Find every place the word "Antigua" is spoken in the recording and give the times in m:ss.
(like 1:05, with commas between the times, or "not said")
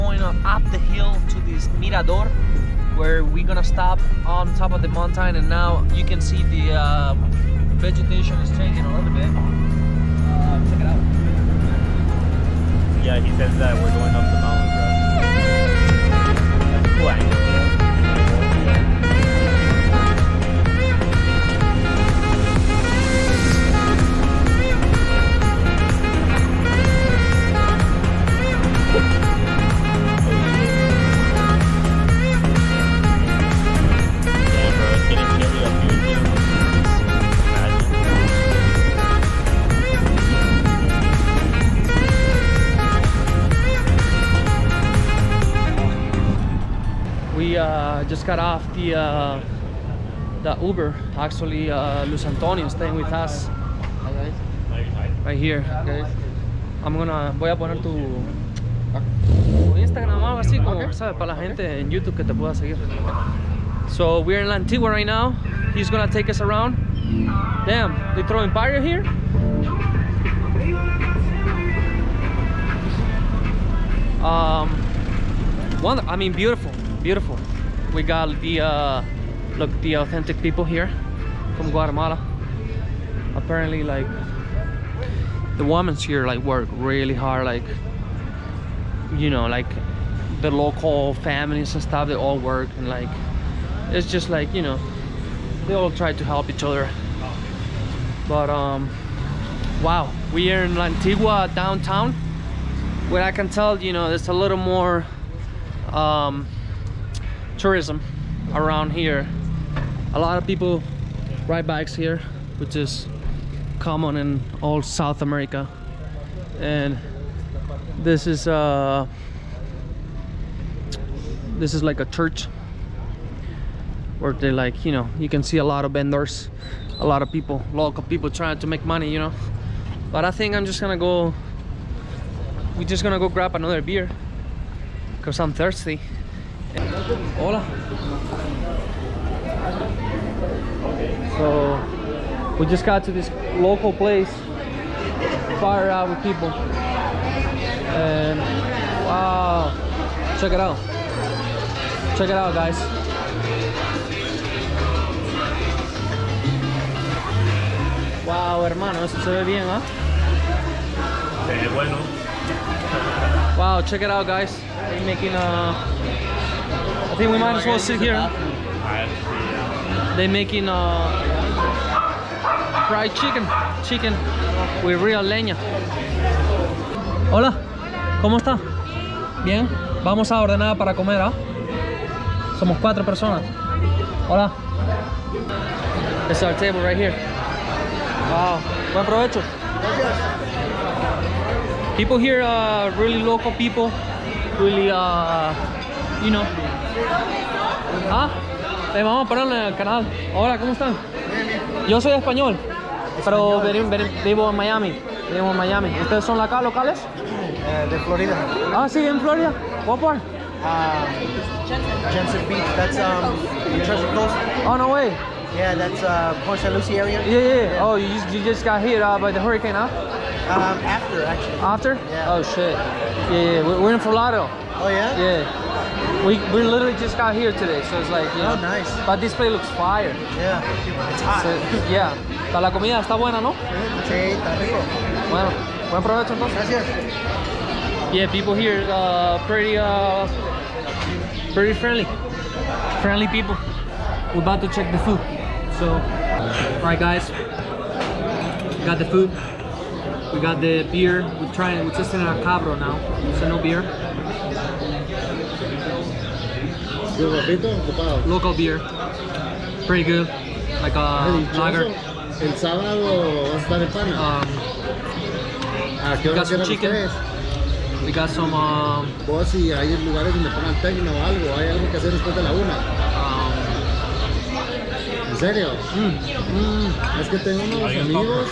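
1:04, 1:40.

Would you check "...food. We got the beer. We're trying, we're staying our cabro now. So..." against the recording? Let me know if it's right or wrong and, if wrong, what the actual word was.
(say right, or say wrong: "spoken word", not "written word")
wrong: "testing", not "staying".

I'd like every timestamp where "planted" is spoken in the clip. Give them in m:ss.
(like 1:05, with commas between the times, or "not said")
not said.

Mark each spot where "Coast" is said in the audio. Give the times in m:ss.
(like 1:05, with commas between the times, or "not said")
3:34.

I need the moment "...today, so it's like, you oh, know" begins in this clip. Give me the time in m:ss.
3:47.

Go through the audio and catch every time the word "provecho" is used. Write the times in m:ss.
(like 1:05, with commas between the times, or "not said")
3:09, 3:56.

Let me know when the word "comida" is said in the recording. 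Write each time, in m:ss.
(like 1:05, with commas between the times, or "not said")
3:52.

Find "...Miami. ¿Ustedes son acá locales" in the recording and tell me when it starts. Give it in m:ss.
3:25.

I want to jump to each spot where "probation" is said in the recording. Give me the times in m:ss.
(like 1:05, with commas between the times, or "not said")
not said.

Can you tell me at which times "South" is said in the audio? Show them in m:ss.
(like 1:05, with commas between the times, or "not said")
1:54.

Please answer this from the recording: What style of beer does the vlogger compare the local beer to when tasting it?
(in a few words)
lager.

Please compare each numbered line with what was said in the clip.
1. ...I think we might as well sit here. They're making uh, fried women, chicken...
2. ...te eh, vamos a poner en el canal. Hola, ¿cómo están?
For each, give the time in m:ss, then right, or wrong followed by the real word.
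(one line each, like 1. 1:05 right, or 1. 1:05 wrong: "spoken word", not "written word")
1. 2:47 wrong: "chicken", not "women"
2. 3:18 right.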